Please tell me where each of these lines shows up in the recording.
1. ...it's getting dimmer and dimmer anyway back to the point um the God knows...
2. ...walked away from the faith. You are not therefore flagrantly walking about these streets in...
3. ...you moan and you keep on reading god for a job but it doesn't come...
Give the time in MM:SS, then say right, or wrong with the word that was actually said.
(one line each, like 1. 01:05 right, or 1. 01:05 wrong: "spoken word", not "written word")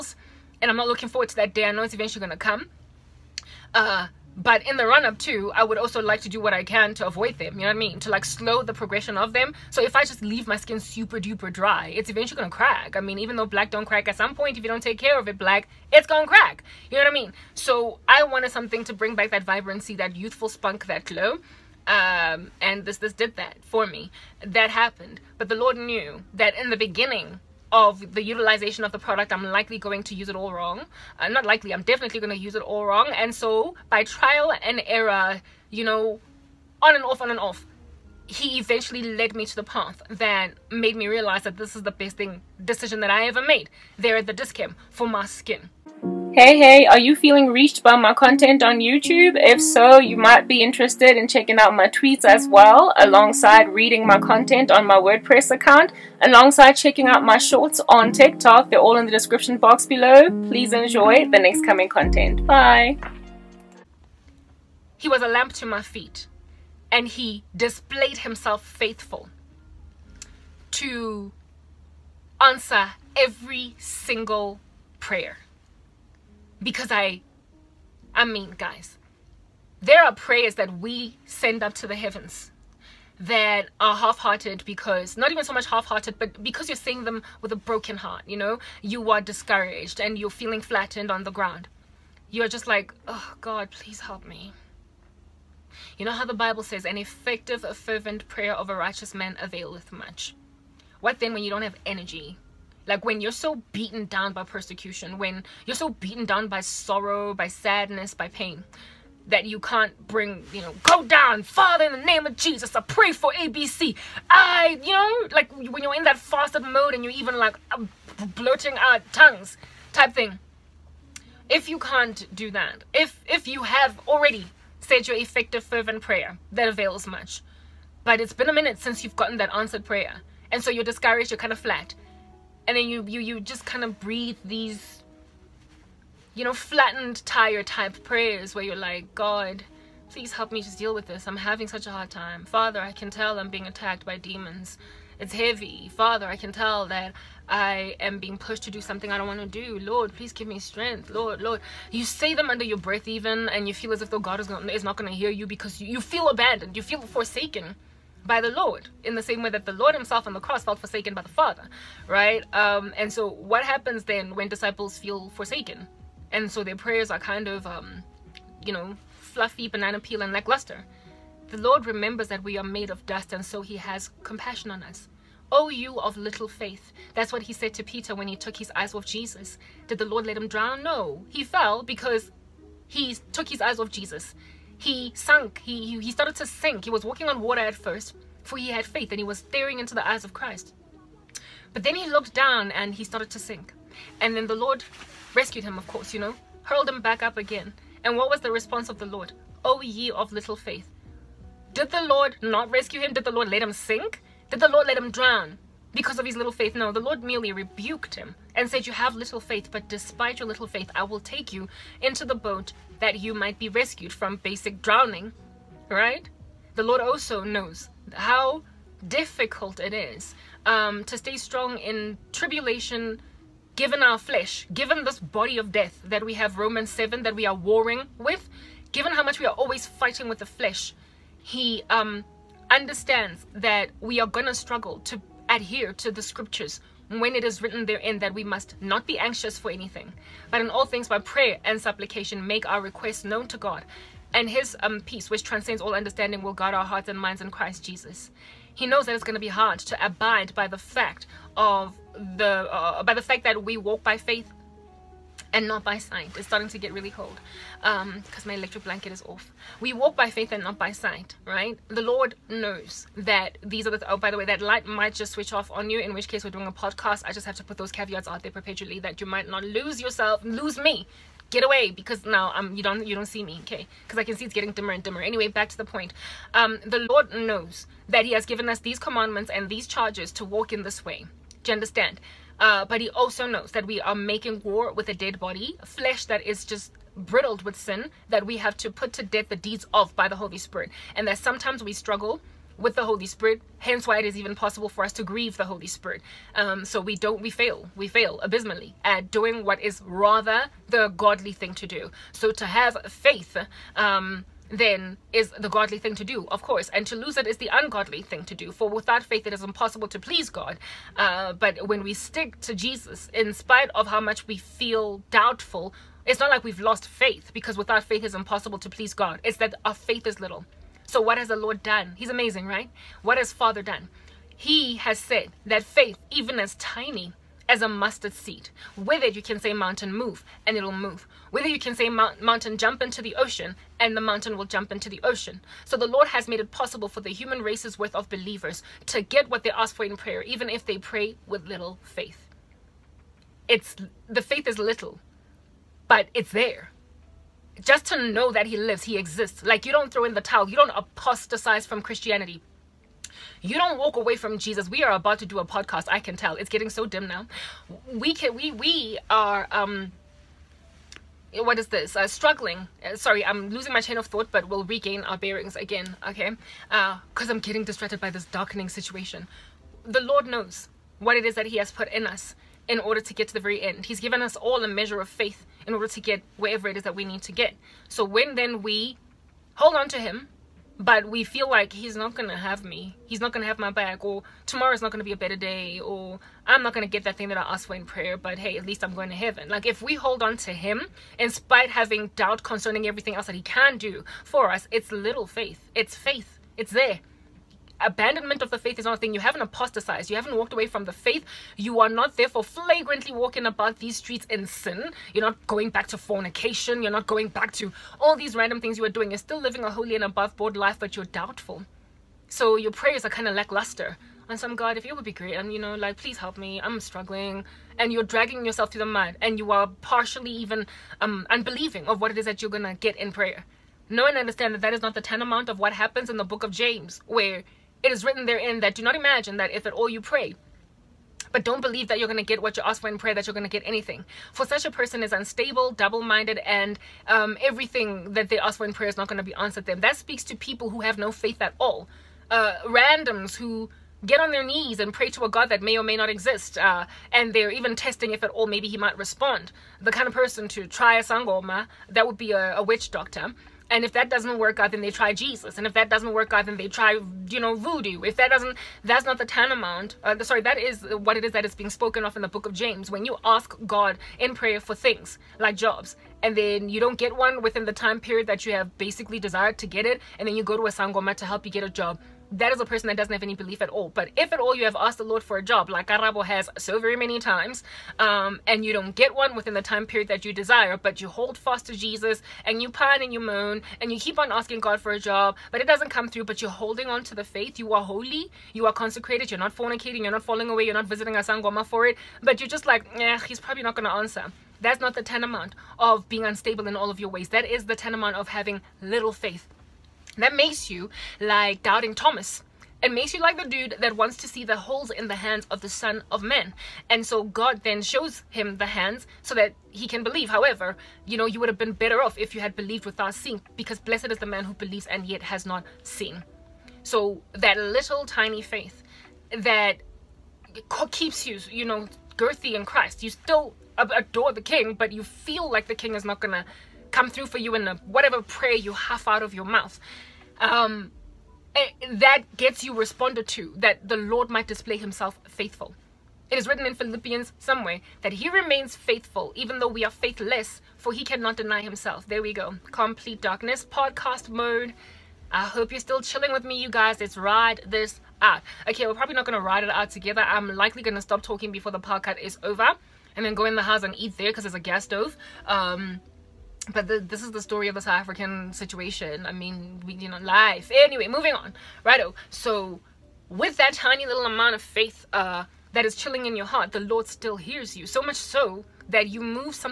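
1. 04:34 wrong: "Lord", not "God"
2. 06:40 right
3. 08:03 wrong: "asking", not "reading".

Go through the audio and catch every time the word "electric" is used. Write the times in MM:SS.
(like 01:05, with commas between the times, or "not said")
04:18.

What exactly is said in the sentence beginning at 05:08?
For without faith, it is impossible to please God.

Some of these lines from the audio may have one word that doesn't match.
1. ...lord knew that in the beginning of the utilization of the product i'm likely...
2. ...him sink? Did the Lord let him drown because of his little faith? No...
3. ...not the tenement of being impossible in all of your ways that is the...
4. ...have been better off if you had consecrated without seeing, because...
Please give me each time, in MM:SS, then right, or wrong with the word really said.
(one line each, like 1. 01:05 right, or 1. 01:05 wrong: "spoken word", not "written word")
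1. 00:25 right
2. 03:23 right
3. 08:14 wrong: "unstable", not "impossible"
4. 08:31 wrong: "believed", not "consecrated".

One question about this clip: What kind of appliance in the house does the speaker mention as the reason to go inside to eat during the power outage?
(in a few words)
gas stove.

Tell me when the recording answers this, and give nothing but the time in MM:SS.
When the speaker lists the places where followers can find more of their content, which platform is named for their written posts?
00:54.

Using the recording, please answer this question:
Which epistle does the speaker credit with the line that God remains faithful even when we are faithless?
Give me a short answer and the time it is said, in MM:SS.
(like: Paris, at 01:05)
Philippians, at 08:56.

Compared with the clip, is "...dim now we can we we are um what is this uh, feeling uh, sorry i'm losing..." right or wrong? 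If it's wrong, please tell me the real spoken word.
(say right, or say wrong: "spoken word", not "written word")
wrong: "struggling", not "feeling".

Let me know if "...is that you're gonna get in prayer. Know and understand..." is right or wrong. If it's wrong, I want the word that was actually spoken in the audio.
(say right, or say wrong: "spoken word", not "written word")
right.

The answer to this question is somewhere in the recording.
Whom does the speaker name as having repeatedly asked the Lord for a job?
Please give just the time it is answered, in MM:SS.
07:56.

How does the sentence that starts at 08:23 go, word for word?
It makes you like the dude that wants to see the holes in the hands of the Son of Man.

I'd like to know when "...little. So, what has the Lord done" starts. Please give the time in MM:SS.
05:20.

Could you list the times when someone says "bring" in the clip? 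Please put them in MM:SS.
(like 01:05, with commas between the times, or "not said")
00:18, 01:50.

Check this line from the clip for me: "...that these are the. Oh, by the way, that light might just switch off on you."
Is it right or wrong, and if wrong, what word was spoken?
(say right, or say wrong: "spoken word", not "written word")
right.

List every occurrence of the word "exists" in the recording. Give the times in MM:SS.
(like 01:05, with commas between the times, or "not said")
05:49, 07:26.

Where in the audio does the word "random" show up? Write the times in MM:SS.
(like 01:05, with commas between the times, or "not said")
06:48, 07:22.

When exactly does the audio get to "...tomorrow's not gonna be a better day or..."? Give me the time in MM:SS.
06:24.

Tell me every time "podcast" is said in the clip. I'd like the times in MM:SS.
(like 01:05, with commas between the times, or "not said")
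04:26, 05:55, 09:03, 09:11.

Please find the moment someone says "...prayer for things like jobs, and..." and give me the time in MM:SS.
07:44.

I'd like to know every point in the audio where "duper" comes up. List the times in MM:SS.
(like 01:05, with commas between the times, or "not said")
00:11.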